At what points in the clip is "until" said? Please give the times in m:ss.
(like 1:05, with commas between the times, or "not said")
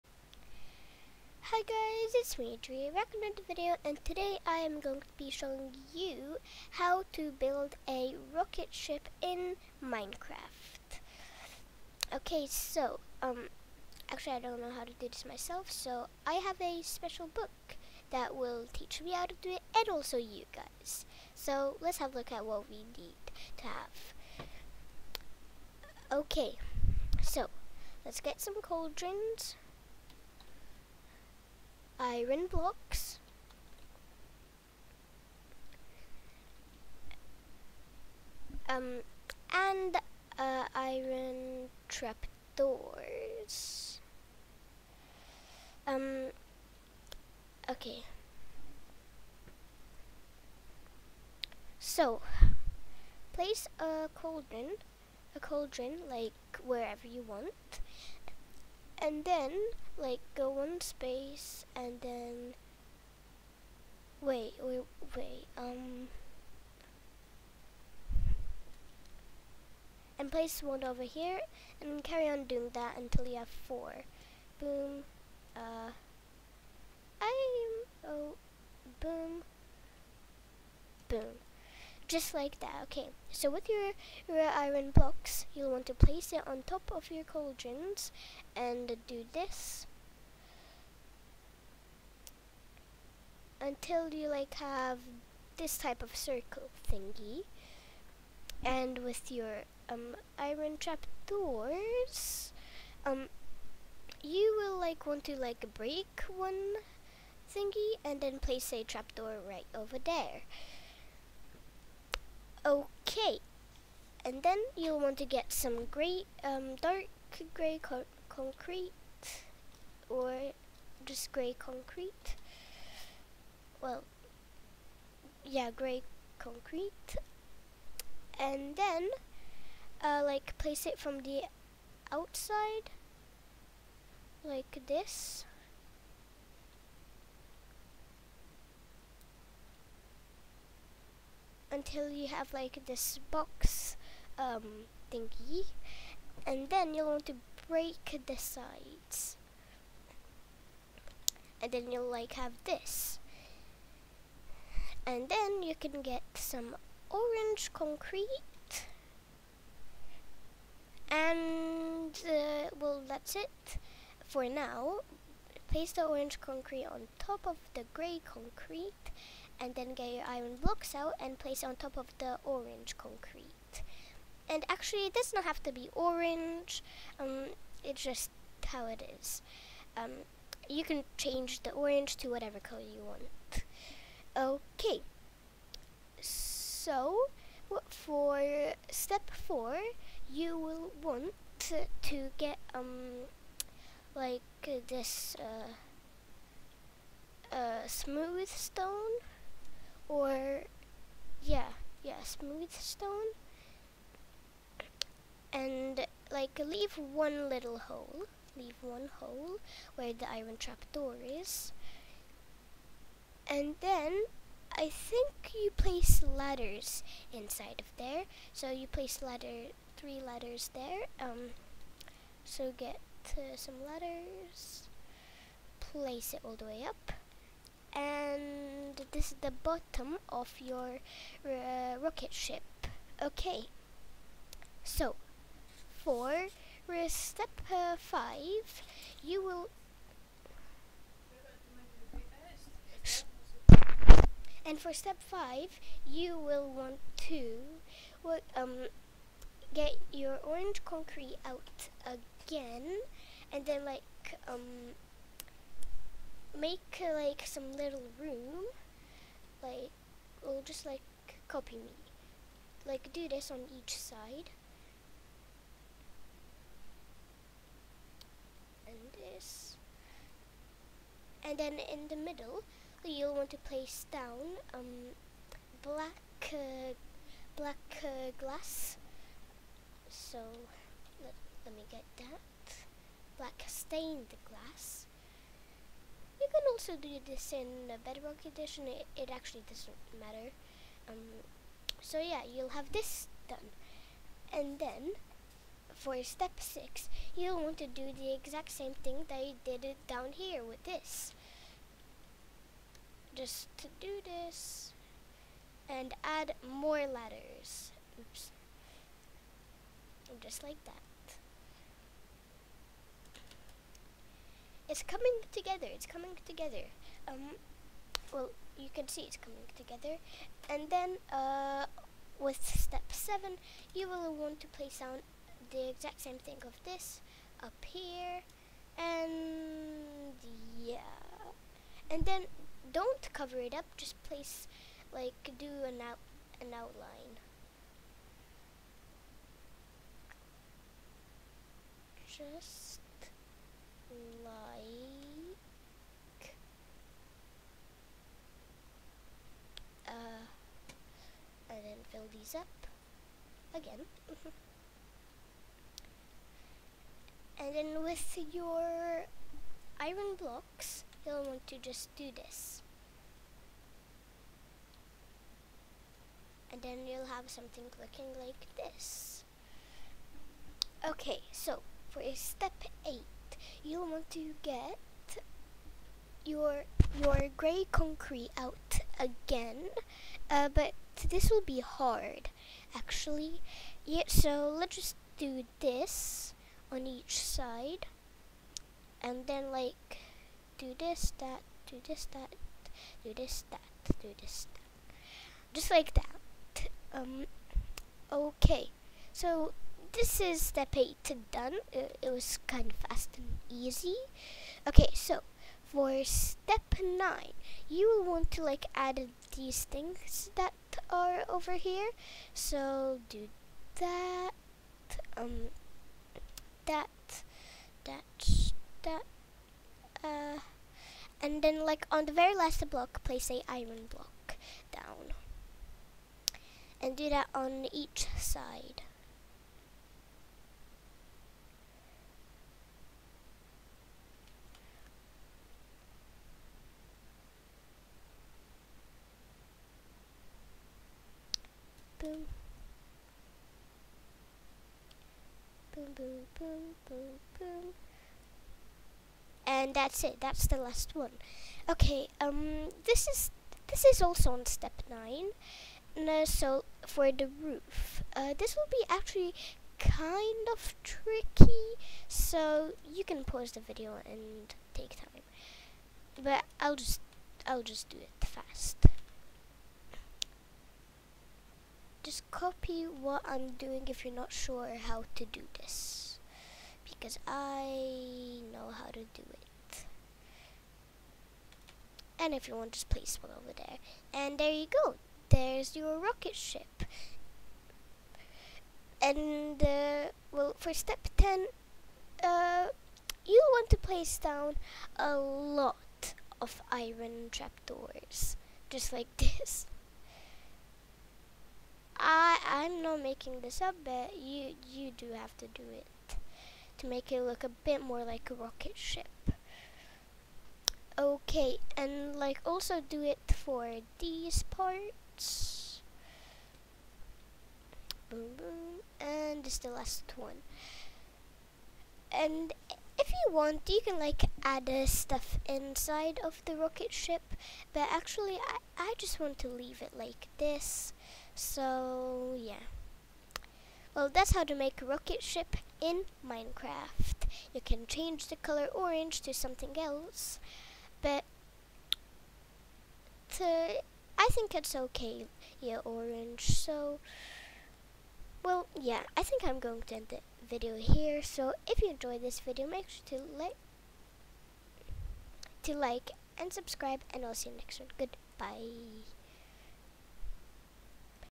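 1:12, 1:33, 2:21.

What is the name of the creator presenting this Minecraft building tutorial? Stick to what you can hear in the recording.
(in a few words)
Adrija.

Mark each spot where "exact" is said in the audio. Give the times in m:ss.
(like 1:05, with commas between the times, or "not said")
4:58, 5:25.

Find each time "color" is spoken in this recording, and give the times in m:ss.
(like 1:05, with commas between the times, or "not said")
3:02, 8:58.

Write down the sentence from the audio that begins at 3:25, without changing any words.
And like leave one little hole, leave one hole where the iron trapdoor is.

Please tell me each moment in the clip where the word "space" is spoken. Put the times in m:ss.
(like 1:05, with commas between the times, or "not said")
1:00.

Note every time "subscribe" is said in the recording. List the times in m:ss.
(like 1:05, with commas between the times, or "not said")
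9:16.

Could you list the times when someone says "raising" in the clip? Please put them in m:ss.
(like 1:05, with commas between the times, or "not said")
not said.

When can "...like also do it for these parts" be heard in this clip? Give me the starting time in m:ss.
8:32.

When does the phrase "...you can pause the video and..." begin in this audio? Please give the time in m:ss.
7:43.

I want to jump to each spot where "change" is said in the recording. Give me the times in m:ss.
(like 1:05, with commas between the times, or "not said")
3:01, 8:58.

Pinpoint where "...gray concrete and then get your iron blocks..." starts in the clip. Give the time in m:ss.
2:47.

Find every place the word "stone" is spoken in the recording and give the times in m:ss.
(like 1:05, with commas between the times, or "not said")
3:18, 3:22.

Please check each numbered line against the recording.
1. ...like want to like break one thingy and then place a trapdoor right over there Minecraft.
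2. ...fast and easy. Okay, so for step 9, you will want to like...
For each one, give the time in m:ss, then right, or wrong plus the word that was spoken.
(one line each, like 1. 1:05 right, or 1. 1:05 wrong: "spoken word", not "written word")
1. 1:44 wrong: "Okay", not "Minecraft"
2. 6:43 right.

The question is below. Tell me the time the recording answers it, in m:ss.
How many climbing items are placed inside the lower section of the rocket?
3:39.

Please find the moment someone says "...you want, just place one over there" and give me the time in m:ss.
8:02.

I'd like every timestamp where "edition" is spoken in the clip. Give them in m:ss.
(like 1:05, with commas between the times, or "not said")
4:48.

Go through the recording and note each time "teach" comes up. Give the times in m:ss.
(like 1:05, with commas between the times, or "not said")
0:18.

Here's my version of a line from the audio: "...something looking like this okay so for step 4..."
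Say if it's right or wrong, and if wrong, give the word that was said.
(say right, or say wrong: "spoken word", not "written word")
wrong: "8", not "4".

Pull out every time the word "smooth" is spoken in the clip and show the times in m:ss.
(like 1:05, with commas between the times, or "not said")
3:17, 3:22.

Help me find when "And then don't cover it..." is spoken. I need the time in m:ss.
5:32.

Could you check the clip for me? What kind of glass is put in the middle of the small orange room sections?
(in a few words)
Black stained glass.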